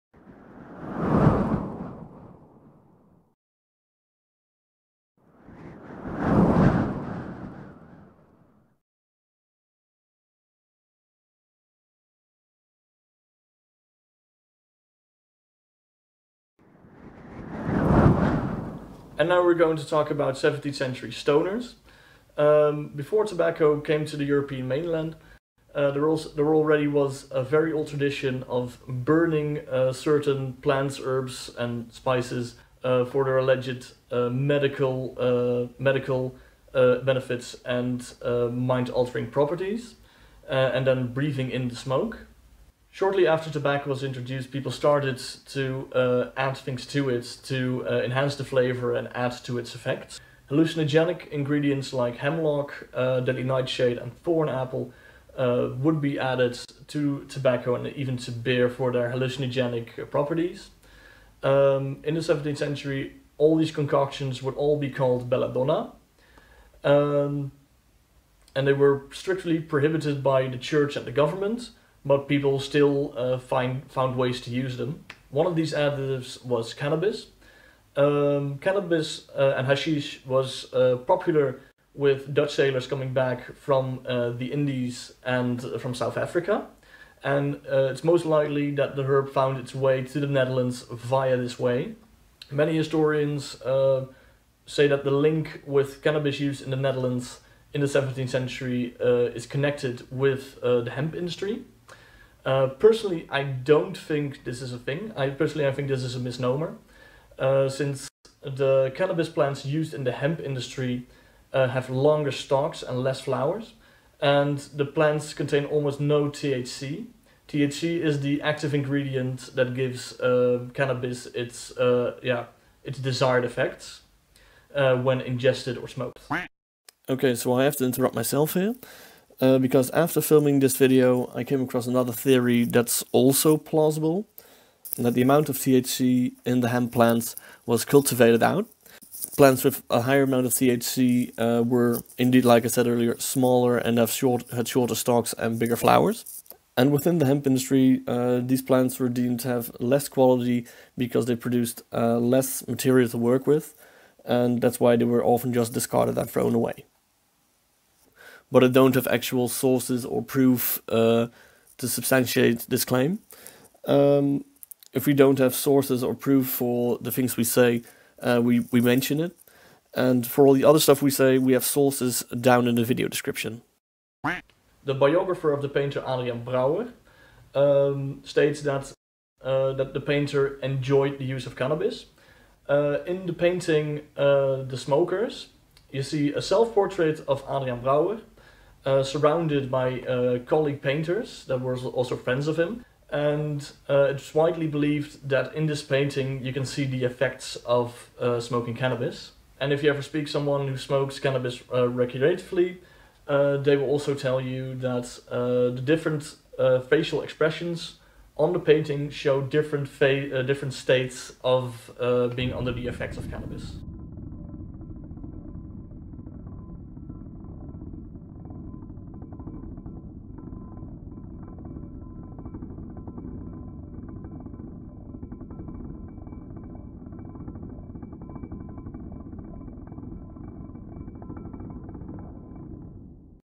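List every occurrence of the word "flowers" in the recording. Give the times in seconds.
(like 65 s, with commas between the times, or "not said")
113 s, 145 s.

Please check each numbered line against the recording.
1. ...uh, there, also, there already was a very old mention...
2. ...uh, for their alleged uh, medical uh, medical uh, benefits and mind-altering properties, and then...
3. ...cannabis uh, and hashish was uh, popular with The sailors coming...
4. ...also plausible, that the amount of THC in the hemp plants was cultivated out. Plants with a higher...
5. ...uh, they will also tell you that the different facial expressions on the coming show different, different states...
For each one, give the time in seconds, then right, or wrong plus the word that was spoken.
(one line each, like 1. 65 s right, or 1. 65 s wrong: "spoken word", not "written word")
1. 25 s wrong: "tradition", not "mention"
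2. 32 s right
3. 78 s wrong: "Dutch", not "The"
4. 133 s right
5. 203 s wrong: "painting", not "coming".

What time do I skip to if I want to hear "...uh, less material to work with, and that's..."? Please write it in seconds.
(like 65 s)
151 s.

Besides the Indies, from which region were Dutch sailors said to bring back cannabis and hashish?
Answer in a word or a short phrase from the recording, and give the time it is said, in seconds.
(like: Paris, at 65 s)
South Africa, at 85 s.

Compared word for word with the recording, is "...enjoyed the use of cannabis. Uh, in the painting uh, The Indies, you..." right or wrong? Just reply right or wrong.
wrong.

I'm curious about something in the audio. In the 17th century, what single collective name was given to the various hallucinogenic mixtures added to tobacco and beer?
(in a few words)
Belladonna.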